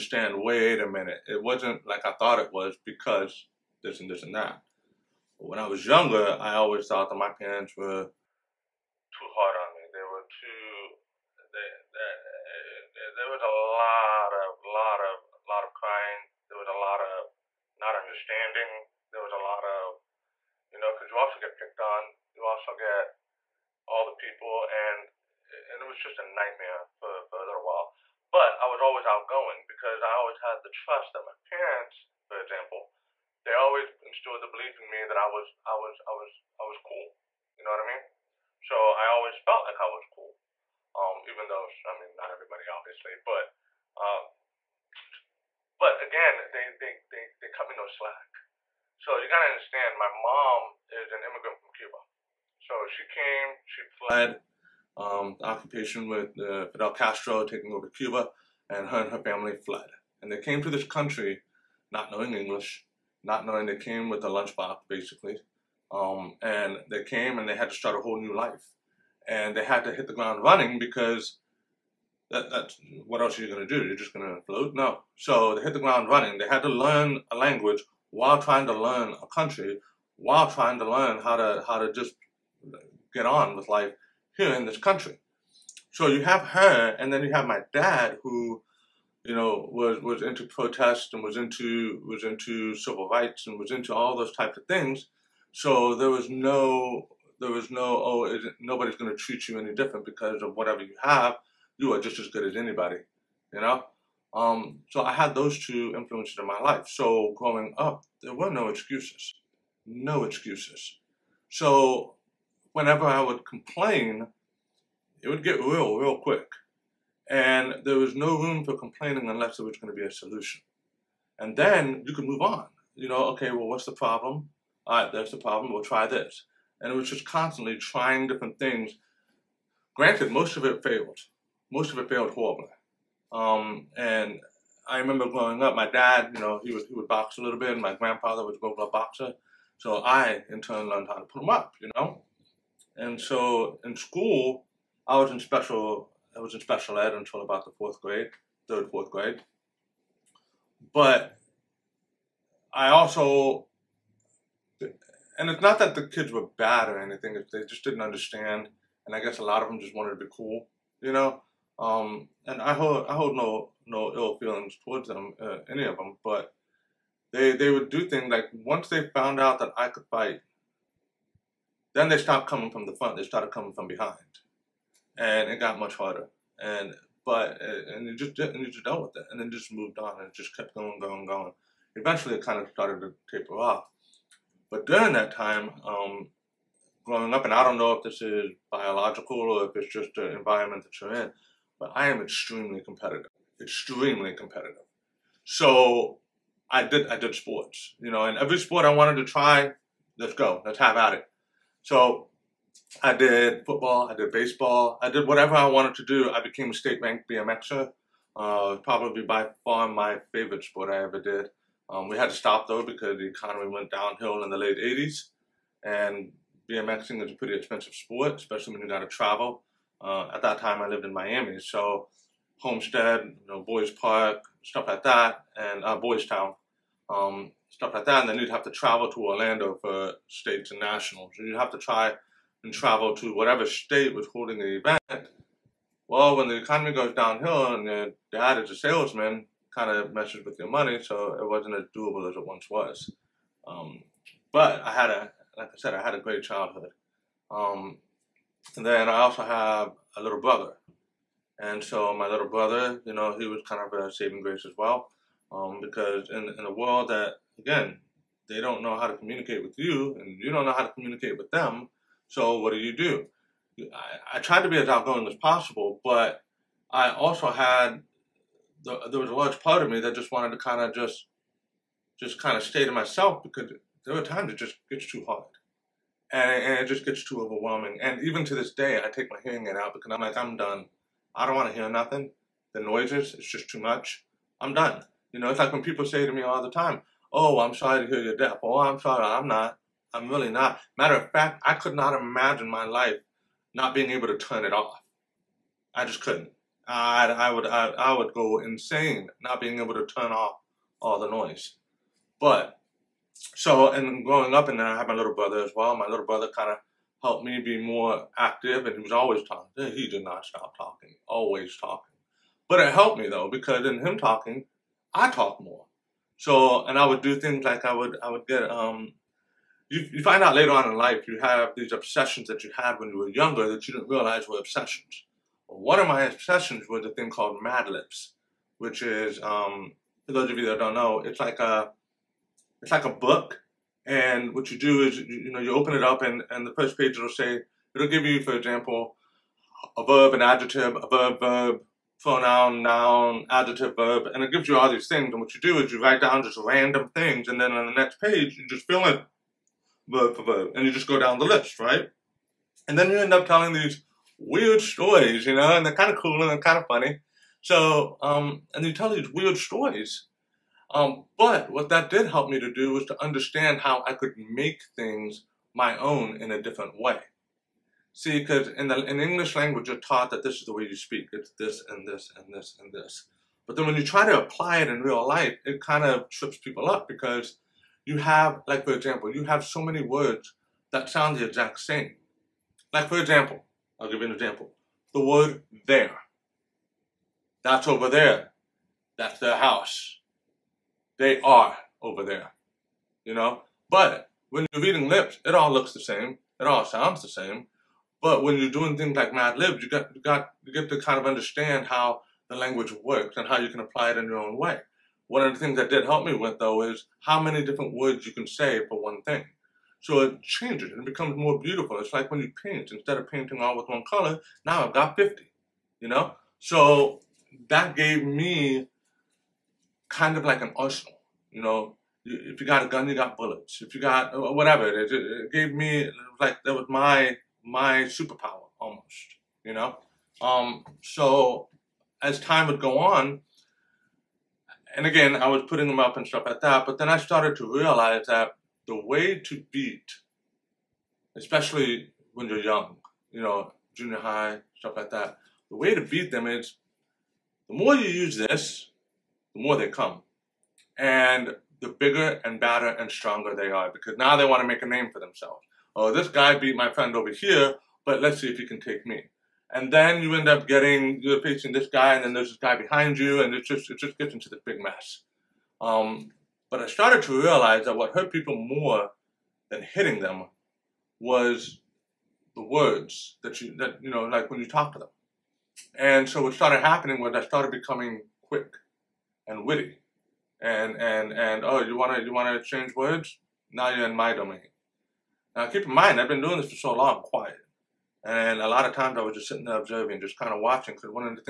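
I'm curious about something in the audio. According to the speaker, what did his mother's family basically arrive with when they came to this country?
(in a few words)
A lunchbox.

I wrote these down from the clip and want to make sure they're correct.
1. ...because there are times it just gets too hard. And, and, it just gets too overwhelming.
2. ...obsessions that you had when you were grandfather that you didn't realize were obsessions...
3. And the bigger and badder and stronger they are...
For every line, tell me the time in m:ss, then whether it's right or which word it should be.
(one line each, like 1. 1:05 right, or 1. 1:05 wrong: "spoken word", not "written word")
1. 4:33 right
2. 5:21 wrong: "younger", not "grandfather"
3. 7:30 right.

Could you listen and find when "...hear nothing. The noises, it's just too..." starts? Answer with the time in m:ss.
4:41.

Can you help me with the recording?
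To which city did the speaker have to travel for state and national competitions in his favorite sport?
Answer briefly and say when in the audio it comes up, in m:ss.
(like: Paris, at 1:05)
Orlando, at 3:49.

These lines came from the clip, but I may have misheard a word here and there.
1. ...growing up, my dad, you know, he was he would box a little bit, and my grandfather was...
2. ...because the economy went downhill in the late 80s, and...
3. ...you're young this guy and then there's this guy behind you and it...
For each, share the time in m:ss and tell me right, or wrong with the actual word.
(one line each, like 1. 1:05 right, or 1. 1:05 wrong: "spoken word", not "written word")
1. 2:15 right
2. 3:32 right
3. 7:41 wrong: "facing", not "young".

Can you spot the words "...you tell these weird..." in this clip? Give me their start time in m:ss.
5:58.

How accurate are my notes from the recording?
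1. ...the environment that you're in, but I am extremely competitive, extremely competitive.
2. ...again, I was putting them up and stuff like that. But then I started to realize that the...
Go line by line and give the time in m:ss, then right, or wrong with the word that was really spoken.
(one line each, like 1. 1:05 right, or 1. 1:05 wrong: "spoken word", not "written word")
1. 3:10 right
2. 7:15 right.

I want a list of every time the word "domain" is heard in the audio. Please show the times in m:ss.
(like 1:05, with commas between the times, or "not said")
8:04.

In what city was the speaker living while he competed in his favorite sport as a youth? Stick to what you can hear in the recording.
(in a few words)
Miami.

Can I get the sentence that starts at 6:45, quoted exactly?
One of the things that did help me with though is how many different words you can say for one thing.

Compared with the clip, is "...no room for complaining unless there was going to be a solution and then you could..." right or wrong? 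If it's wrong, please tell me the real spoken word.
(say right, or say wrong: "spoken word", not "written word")
right.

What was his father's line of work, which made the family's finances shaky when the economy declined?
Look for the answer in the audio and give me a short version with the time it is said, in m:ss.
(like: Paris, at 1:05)
Salesman, at 3:58.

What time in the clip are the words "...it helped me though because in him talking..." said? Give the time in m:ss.
5:12.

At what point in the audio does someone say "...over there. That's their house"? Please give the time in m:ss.
6:27.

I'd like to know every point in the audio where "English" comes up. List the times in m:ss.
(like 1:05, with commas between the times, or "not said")
1:02, 6:09.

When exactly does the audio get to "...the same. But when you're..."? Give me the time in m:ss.
6:37.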